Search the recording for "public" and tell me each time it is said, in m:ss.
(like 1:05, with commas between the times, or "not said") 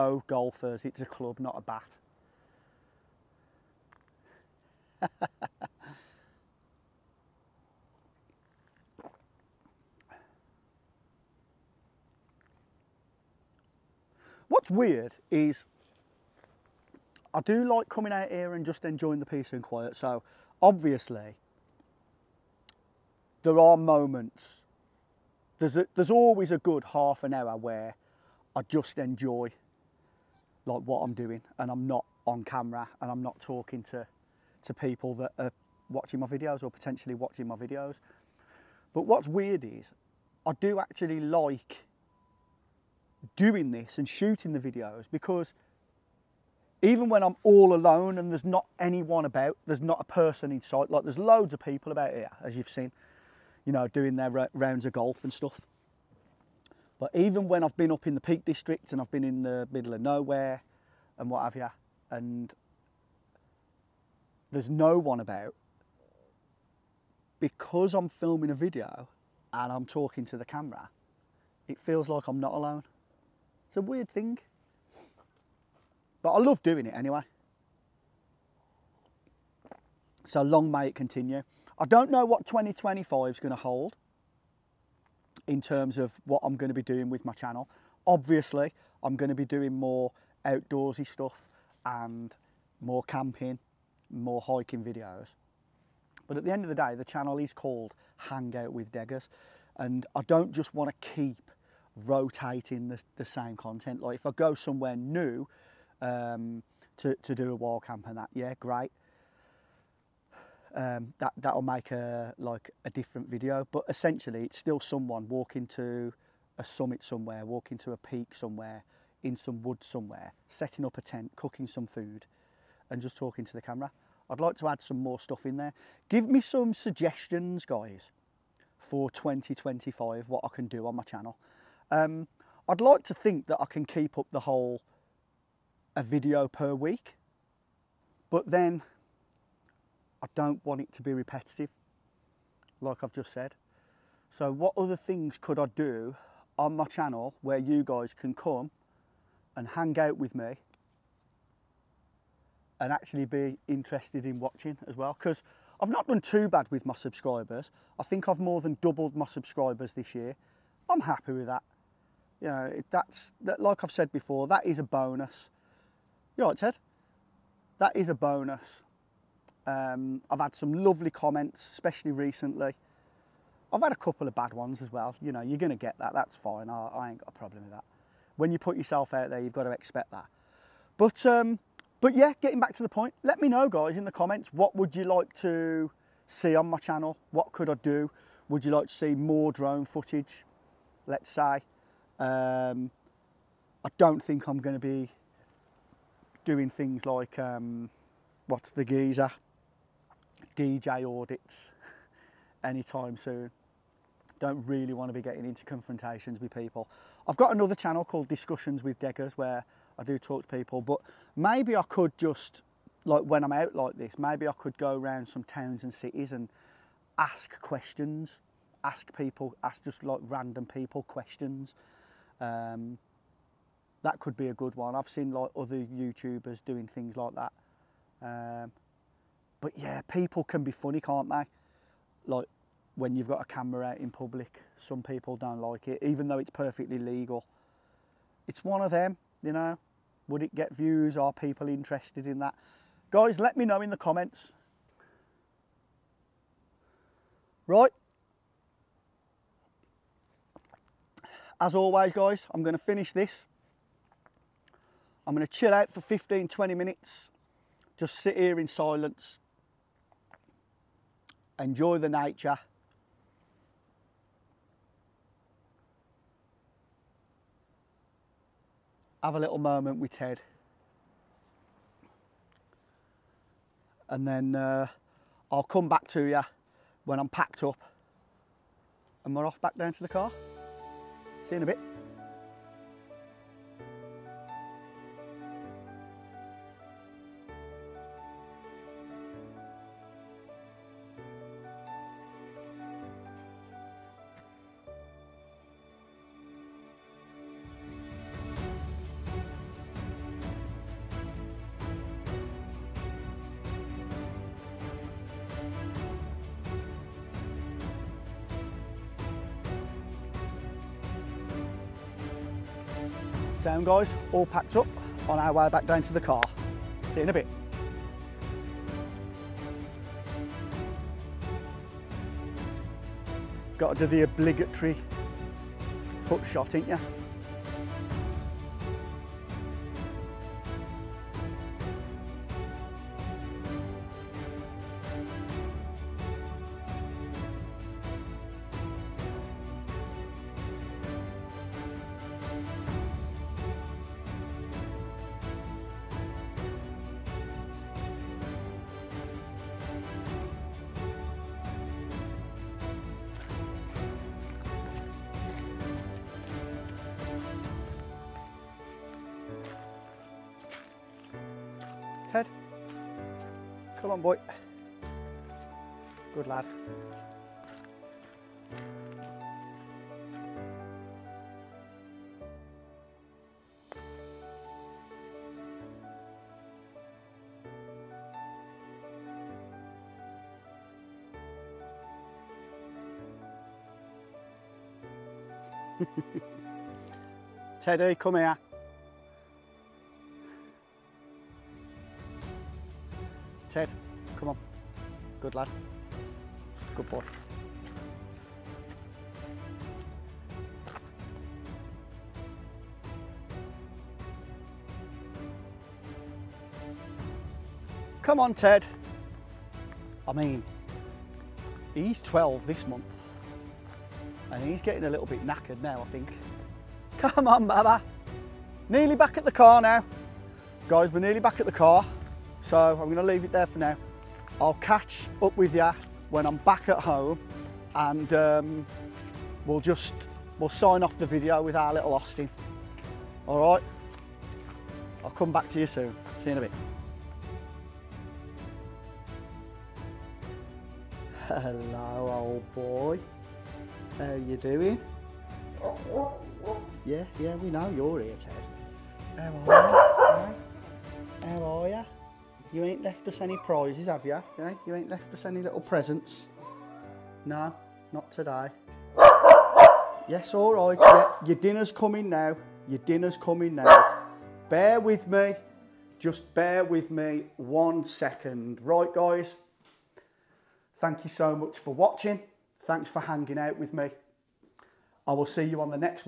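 3:54.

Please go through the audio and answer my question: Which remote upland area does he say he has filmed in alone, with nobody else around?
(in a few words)
Peak District.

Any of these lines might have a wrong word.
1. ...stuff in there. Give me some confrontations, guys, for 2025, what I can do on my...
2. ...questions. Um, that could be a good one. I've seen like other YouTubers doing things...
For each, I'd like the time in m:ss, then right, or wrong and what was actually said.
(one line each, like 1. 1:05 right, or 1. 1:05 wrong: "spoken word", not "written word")
1. 2:05 wrong: "suggestions", not "confrontations"
2. 3:41 right.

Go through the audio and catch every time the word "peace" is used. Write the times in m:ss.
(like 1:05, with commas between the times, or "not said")
0:19.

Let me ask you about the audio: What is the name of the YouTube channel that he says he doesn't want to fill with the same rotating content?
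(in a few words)
Hangout with Deggers.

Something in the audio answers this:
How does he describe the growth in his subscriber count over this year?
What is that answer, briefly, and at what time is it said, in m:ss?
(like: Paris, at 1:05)
more than doubled, at 2:38.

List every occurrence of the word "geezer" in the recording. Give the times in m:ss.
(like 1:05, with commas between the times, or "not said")
3:18.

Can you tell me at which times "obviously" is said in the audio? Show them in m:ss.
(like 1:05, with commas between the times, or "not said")
0:20, 1:28.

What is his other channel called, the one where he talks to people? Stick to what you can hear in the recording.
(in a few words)
Discussions with Deggers.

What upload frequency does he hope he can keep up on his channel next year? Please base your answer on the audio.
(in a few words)
a video per week.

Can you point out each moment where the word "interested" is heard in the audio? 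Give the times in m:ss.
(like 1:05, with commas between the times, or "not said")
2:33, 4:01.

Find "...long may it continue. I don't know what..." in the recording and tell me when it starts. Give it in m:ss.
1:20.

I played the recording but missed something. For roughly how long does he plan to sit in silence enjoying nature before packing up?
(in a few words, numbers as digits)
15, 20 minutes.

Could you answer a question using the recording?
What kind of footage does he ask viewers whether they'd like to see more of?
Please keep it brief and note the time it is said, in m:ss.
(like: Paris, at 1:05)
drone footage, at 3:09.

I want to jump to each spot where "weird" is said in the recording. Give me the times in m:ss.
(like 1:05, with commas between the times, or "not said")
0:14, 0:39, 1:13.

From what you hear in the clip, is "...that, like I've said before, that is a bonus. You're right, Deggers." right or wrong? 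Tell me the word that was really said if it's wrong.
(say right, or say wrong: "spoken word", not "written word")
wrong: "Ted", not "Deggers".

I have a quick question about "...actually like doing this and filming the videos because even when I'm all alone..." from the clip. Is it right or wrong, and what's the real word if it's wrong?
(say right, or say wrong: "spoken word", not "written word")
wrong: "shooting", not "filming".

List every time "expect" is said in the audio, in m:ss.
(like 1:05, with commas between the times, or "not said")
2:59.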